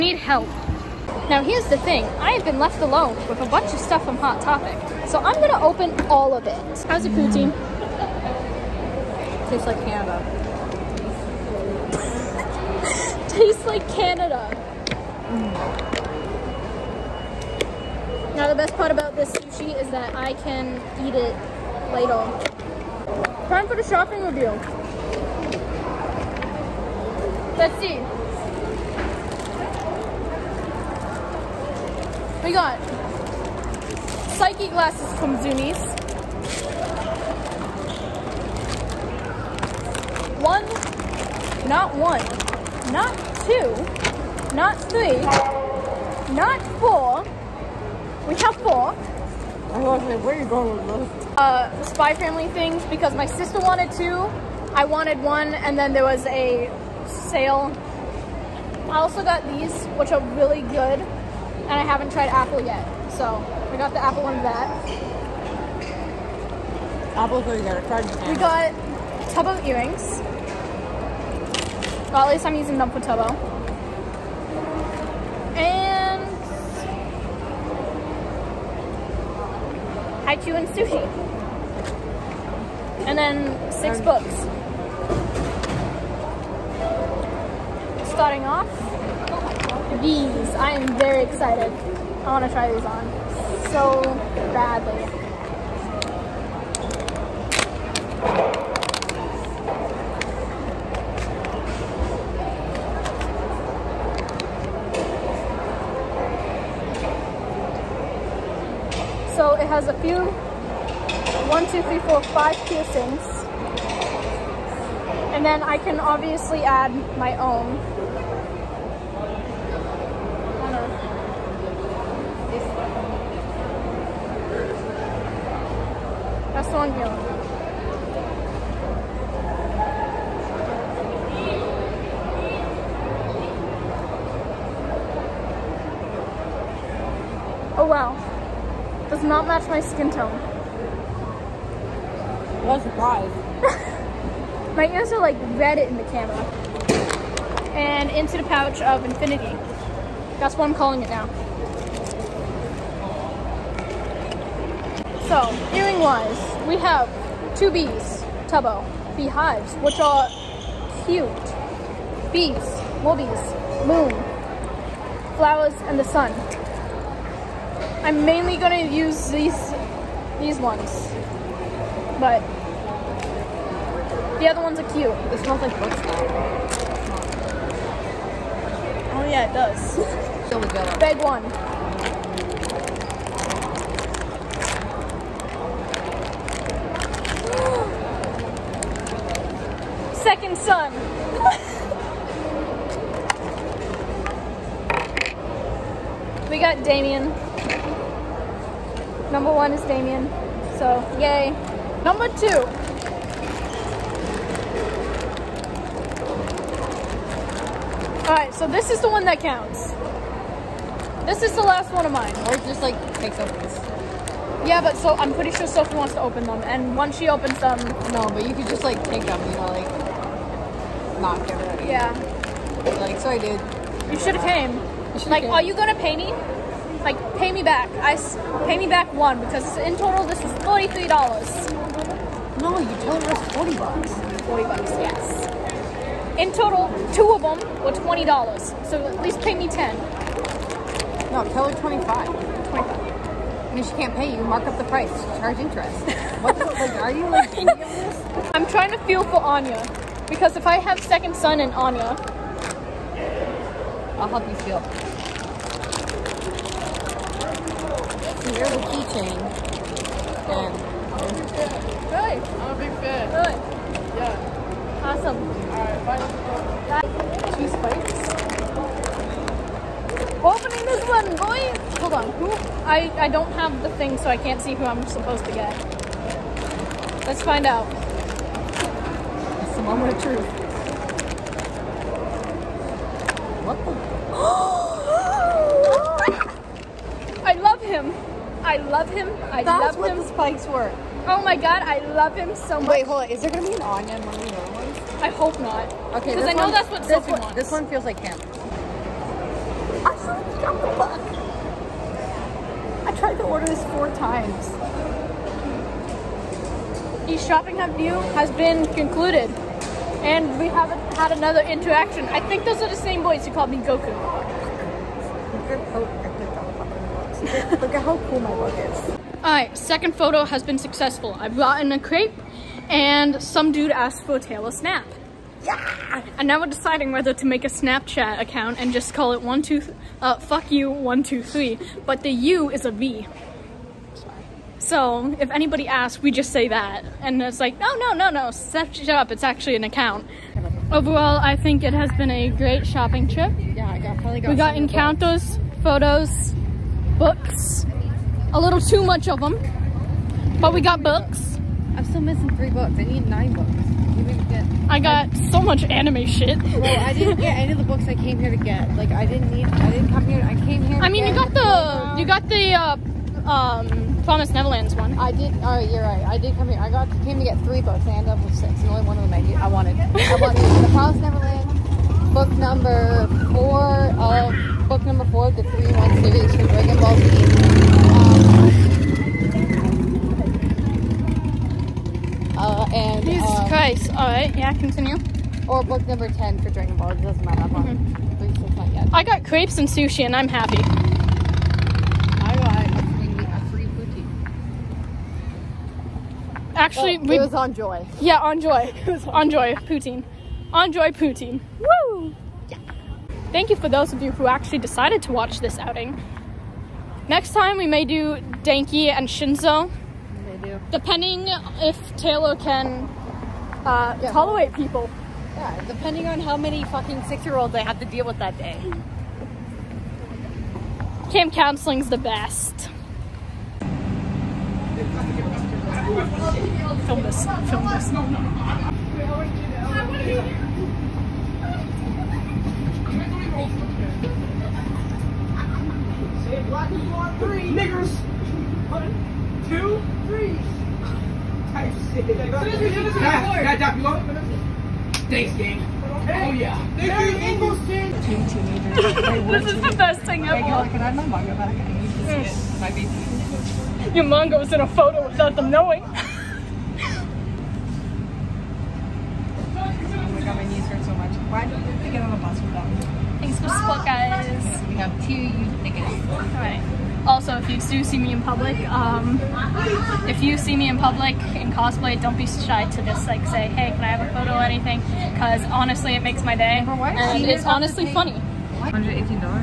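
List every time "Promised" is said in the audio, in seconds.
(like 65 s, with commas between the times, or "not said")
364 s, 370 s.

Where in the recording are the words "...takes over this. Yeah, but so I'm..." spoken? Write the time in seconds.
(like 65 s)
213 s.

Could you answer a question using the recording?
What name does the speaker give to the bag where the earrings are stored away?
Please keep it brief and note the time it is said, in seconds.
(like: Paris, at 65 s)
pouch of infinity, at 148 s.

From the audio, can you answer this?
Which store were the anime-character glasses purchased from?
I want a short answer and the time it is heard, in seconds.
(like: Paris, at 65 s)
Zumiez, at 35 s.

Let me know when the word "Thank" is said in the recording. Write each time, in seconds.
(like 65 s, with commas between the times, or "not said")
403 s, 441 s, 446 s, 463 s.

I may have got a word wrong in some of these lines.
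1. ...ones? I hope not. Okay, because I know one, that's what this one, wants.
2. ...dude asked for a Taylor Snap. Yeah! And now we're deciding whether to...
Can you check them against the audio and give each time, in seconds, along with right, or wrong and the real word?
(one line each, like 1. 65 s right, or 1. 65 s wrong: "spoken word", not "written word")
1. 294 s right
2. 323 s right.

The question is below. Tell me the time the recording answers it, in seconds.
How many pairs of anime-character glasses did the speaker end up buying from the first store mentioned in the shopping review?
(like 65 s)
48 s.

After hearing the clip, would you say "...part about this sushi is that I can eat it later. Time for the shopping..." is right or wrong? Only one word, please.
right.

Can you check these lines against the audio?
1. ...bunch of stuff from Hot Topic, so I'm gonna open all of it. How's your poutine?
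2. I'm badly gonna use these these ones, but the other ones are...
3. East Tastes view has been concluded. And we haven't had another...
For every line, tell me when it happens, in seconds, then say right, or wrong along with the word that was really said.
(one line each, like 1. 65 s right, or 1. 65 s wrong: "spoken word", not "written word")
1. 3 s right
2. 168 s wrong: "mainly", not "badly"
3. 307 s wrong: "Shopping", not "Tastes".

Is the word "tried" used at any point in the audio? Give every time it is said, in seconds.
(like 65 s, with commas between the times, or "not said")
62 s, 303 s.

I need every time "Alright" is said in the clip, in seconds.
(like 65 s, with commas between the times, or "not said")
208 s, 265 s, 319 s, 466 s.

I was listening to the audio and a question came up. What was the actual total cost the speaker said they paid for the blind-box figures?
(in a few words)
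$43.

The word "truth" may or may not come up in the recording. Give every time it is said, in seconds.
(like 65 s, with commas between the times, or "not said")
280 s.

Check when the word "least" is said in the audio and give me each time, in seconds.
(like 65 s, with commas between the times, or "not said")
72 s, 239 s.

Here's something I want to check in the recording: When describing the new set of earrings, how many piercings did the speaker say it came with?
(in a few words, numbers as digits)
5.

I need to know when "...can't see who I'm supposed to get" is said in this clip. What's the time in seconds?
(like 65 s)
274 s.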